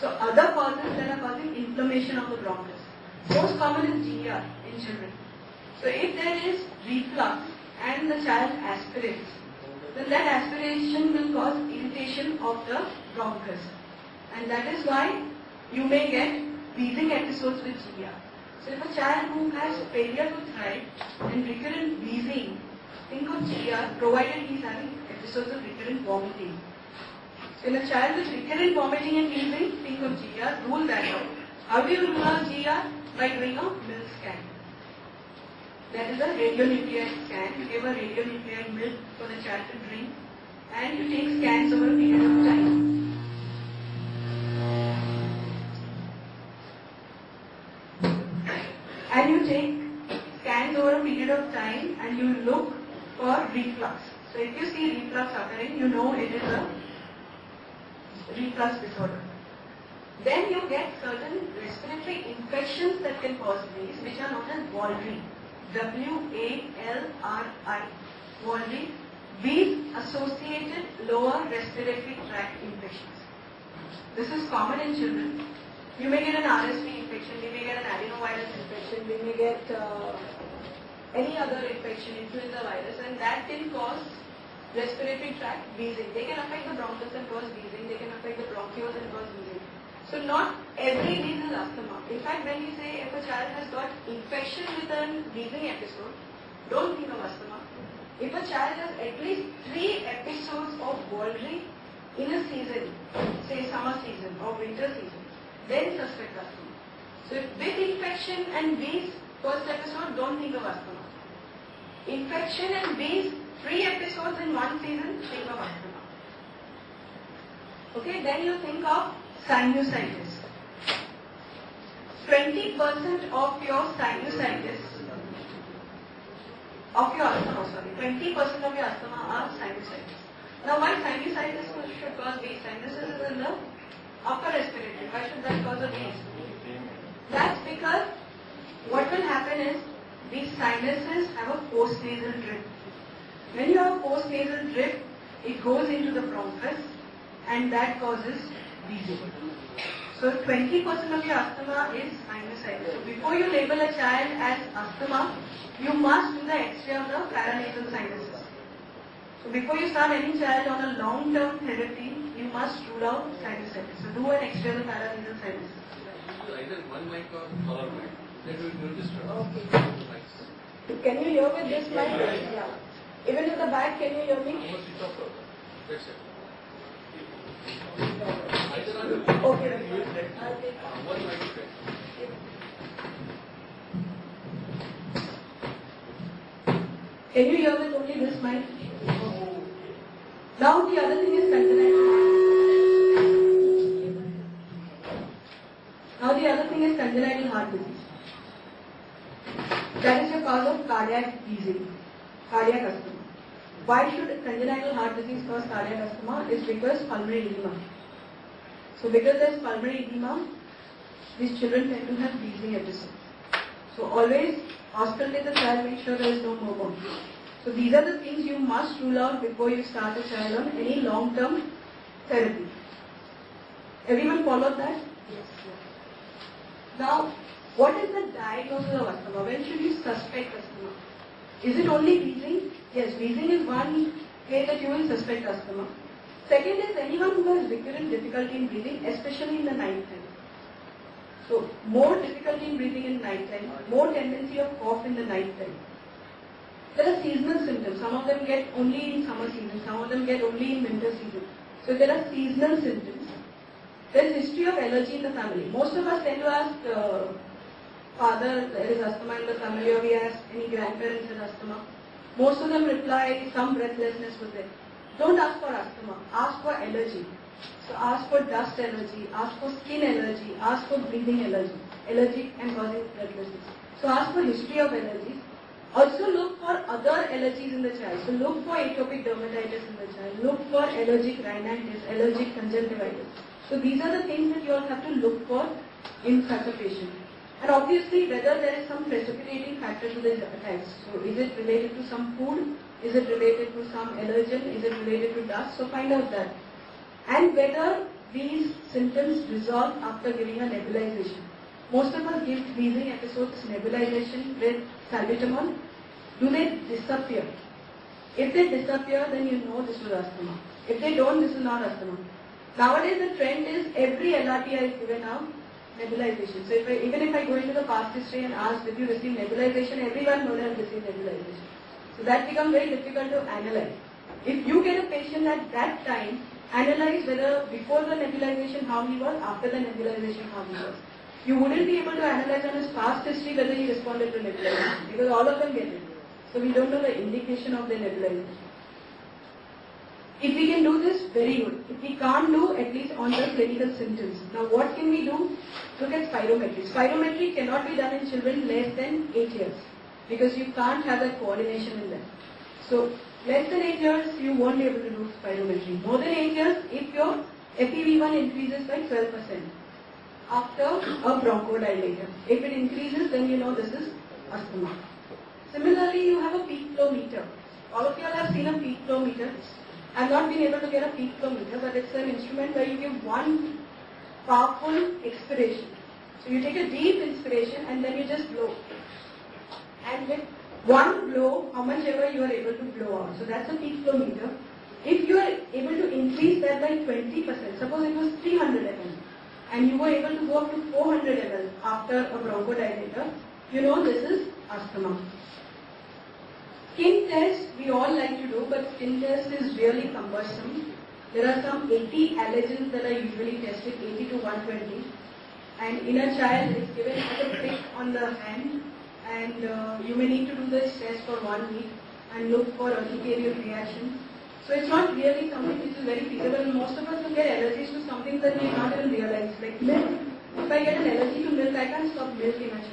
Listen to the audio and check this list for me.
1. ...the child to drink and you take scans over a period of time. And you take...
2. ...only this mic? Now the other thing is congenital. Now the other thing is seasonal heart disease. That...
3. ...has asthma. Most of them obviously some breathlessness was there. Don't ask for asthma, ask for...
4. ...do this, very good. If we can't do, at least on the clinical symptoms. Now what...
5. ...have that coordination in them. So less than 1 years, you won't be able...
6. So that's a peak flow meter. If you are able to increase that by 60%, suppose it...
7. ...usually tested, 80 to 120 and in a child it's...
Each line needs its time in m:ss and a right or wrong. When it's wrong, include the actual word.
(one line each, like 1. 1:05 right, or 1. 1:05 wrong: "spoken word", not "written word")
1. 0:39 right
2. 3:07 wrong: "congenital", not "seasonal"
3. 4:21 wrong: "reply", not "obviously"
4. 5:40 right
5. 5:51 wrong: "8", not "1"
6. 6:23 wrong: "20", not "60"
7. 6:43 right.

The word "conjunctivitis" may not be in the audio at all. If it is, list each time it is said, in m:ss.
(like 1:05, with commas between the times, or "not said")
4:42.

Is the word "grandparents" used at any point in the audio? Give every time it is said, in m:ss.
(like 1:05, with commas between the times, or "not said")
4:20.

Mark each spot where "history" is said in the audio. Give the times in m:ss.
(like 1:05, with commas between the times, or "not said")
4:14, 4:34, 5:18, 5:33.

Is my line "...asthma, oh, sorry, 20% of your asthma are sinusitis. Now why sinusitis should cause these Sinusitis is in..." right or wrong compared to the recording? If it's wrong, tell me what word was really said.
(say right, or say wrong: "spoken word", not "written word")
right.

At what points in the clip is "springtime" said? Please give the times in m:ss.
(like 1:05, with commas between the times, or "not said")
not said.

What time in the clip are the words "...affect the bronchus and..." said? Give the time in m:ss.
1:26.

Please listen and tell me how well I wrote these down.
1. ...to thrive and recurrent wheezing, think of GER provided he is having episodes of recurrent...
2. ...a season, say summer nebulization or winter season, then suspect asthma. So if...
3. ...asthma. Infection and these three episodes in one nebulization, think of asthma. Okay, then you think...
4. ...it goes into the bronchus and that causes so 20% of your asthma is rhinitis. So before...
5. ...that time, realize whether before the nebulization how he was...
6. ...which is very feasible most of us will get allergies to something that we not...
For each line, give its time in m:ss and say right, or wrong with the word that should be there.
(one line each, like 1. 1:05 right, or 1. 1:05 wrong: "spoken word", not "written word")
1. 0:20 right
2. 1:42 wrong: "season", not "nebulization"
3. 1:50 wrong: "season", not "nebulization"
4. 2:25 wrong: "sinusitis", not "rhinitis"
5. 5:25 wrong: "analyze", not "realize"
6. 6:55 right.